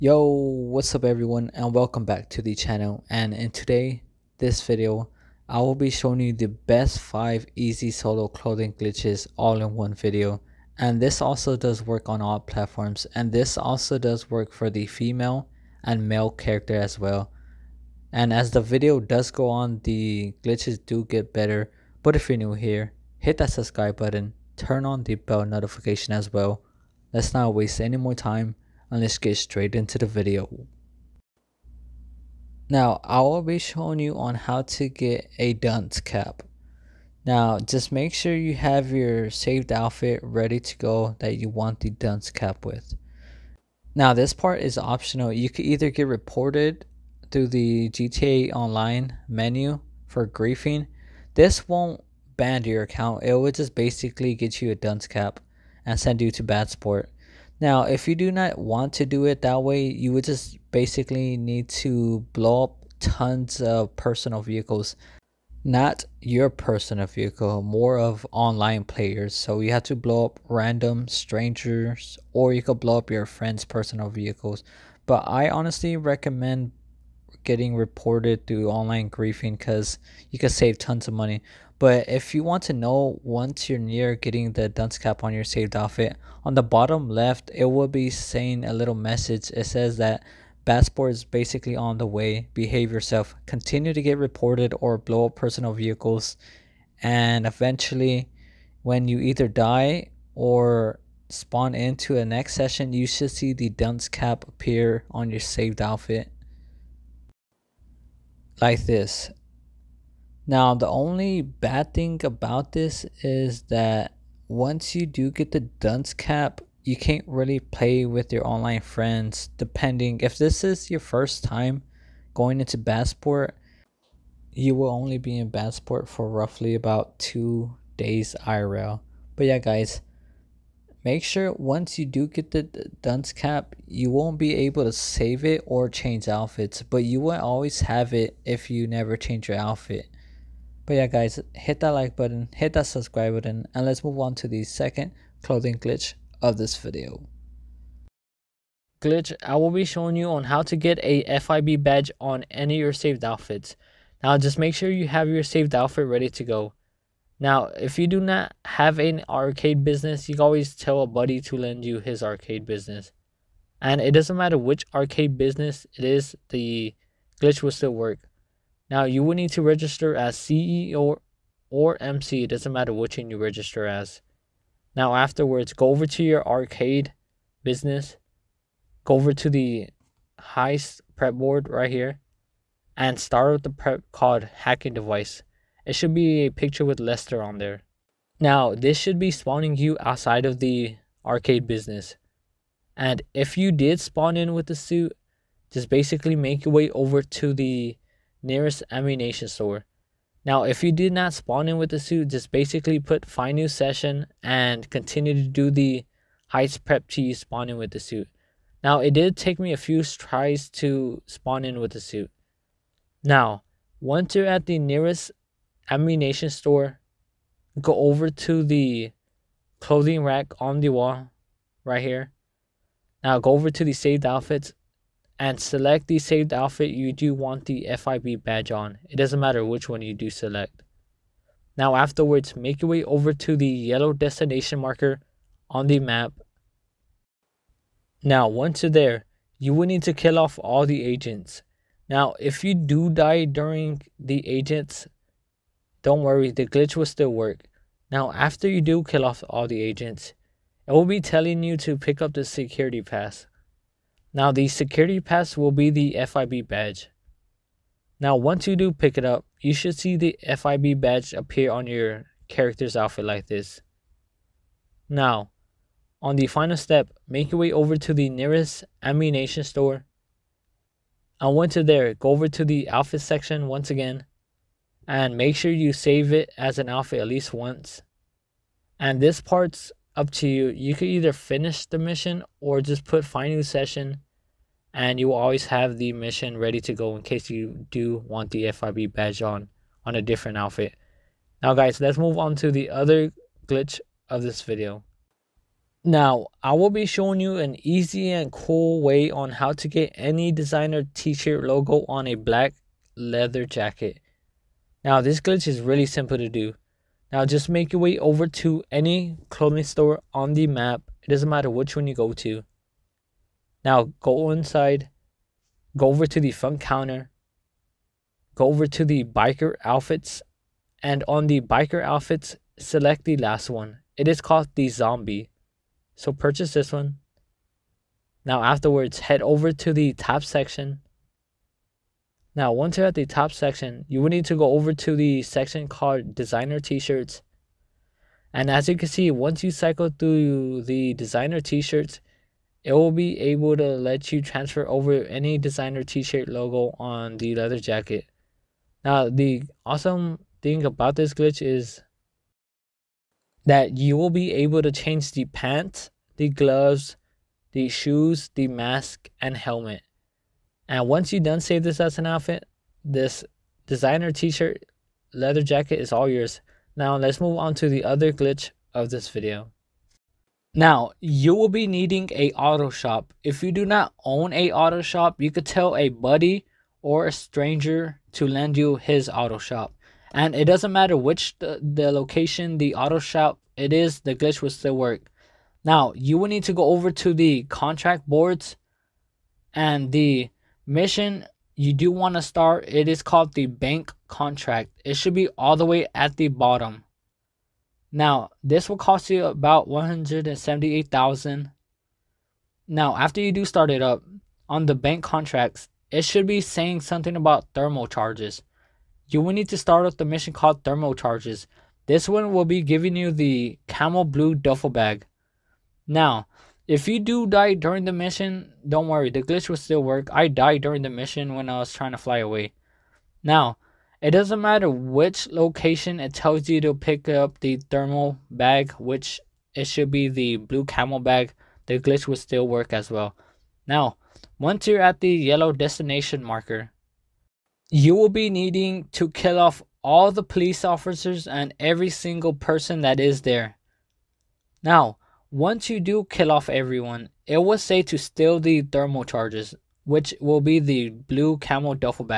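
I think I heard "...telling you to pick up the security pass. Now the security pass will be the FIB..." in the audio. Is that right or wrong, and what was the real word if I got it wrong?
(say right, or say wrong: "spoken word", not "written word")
right.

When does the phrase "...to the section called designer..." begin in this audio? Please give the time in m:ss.
5:34.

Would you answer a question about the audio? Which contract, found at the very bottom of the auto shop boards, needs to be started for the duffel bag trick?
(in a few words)
the bank contract.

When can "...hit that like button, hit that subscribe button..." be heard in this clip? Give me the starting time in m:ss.
2:21.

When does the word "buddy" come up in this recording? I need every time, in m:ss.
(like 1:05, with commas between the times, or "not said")
2:41, 6:16.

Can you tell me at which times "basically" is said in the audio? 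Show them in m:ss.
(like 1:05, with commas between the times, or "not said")
0:53, 1:00, 1:31, 3:15, 3:22.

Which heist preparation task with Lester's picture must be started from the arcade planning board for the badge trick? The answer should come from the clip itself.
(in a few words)
hacking device.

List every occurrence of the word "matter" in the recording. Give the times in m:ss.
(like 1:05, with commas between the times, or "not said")
2:44, 2:52, 3:49, 5:11, 6:20, 7:04.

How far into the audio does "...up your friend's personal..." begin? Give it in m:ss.
1:12.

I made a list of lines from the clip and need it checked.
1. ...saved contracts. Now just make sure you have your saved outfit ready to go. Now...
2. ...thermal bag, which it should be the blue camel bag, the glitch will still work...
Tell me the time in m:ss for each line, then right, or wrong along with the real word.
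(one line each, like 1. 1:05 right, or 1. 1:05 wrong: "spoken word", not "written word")
1. 2:32 wrong: "outfits", not "contracts"
2. 7:07 right.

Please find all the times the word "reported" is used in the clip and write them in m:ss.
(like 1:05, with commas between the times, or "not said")
0:46, 1:17, 1:34.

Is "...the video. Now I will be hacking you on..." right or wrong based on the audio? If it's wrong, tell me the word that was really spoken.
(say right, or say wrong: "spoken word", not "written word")
wrong: "showing", not "hacking".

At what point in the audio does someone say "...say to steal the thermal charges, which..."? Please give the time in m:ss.
7:27.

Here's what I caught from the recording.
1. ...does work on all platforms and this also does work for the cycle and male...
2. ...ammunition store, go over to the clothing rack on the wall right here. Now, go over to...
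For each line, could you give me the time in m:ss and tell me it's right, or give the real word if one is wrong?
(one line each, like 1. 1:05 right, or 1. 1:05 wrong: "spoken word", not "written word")
1. 0:11 wrong: "female", not "cycle"
2. 3:35 right.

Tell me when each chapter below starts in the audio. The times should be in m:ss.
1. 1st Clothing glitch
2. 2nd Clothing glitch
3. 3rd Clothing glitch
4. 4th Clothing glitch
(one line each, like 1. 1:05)
1. 0:29
2. 2:27
3. 4:55
4. 6:09.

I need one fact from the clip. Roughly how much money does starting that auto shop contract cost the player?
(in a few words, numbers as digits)
178,000.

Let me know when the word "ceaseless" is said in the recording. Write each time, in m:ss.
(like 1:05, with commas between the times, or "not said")
not said.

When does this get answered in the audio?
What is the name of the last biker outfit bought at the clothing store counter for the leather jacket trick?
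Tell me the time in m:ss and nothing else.
5:24.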